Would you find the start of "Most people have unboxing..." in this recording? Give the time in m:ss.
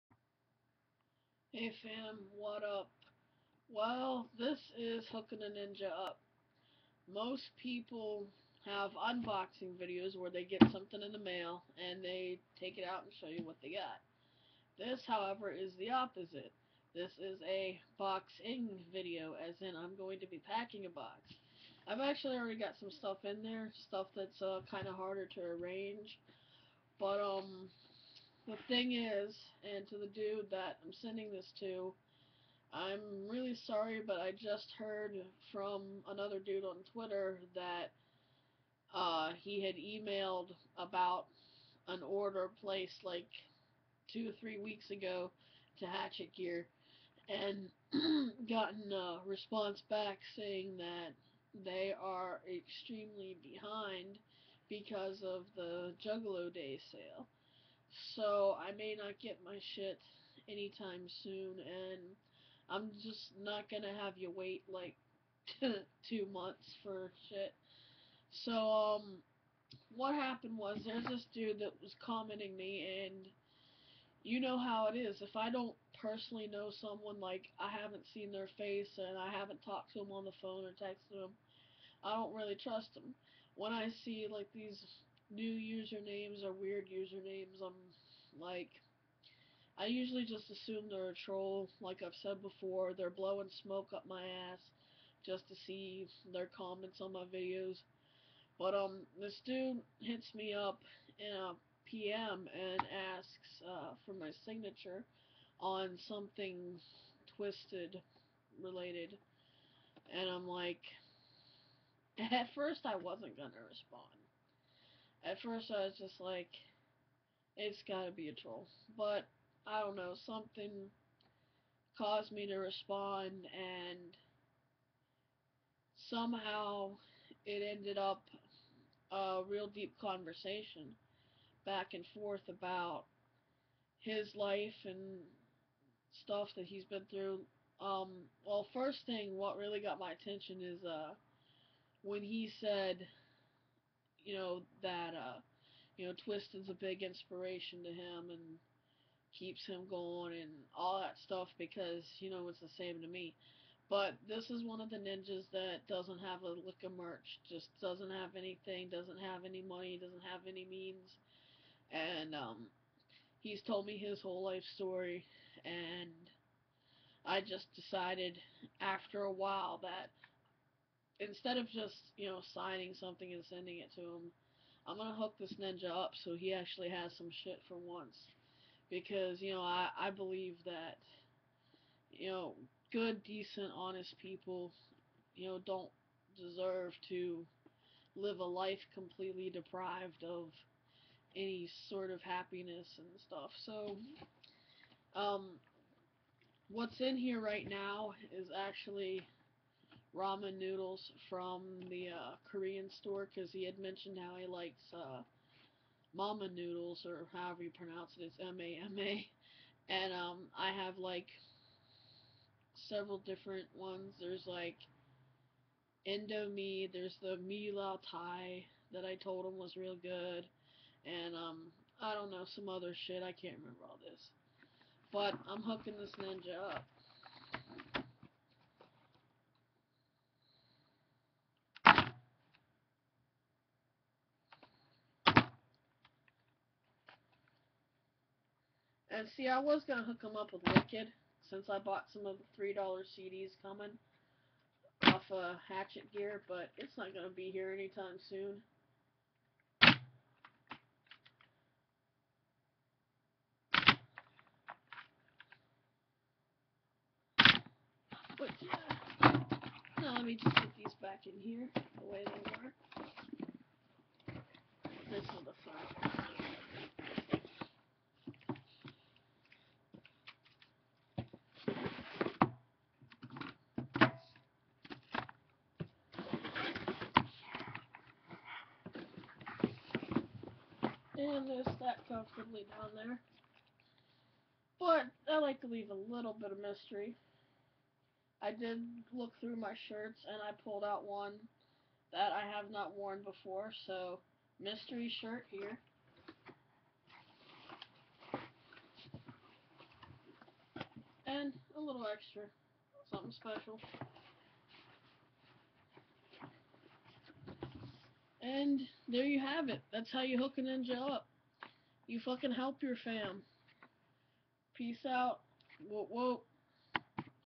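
0:07.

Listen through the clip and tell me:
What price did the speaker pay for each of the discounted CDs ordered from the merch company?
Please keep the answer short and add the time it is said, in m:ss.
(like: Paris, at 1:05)
$3, at 4:02.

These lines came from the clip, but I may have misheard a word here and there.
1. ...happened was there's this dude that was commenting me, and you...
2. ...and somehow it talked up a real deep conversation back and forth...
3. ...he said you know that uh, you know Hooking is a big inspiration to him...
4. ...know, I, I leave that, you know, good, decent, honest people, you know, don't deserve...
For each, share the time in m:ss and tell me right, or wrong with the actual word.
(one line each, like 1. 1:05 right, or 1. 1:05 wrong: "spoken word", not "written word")
1. 1:10 right
2. 2:03 wrong: "ended", not "talked"
3. 2:22 wrong: "Twist", not "Hooking"
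4. 2:59 wrong: "believe", not "leave".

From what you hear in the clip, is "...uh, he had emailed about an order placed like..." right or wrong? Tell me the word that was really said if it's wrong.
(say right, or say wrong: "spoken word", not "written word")
right.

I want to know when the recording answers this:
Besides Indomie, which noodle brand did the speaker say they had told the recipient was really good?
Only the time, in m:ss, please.
3:37.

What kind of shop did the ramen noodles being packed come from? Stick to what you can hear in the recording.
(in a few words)
Korean store.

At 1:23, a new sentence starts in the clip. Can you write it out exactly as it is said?
When I see like these new usernames or weird usernames.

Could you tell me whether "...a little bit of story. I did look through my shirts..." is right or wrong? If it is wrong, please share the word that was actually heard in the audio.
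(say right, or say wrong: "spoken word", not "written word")
wrong: "mystery", not "story".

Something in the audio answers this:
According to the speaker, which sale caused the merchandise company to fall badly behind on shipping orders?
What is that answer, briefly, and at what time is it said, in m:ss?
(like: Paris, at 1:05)
Juggalo Day sale, at 0:56.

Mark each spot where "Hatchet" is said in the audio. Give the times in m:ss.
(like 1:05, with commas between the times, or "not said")
0:45, 4:05.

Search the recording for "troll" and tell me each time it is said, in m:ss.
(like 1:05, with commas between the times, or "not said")
1:31, 1:58.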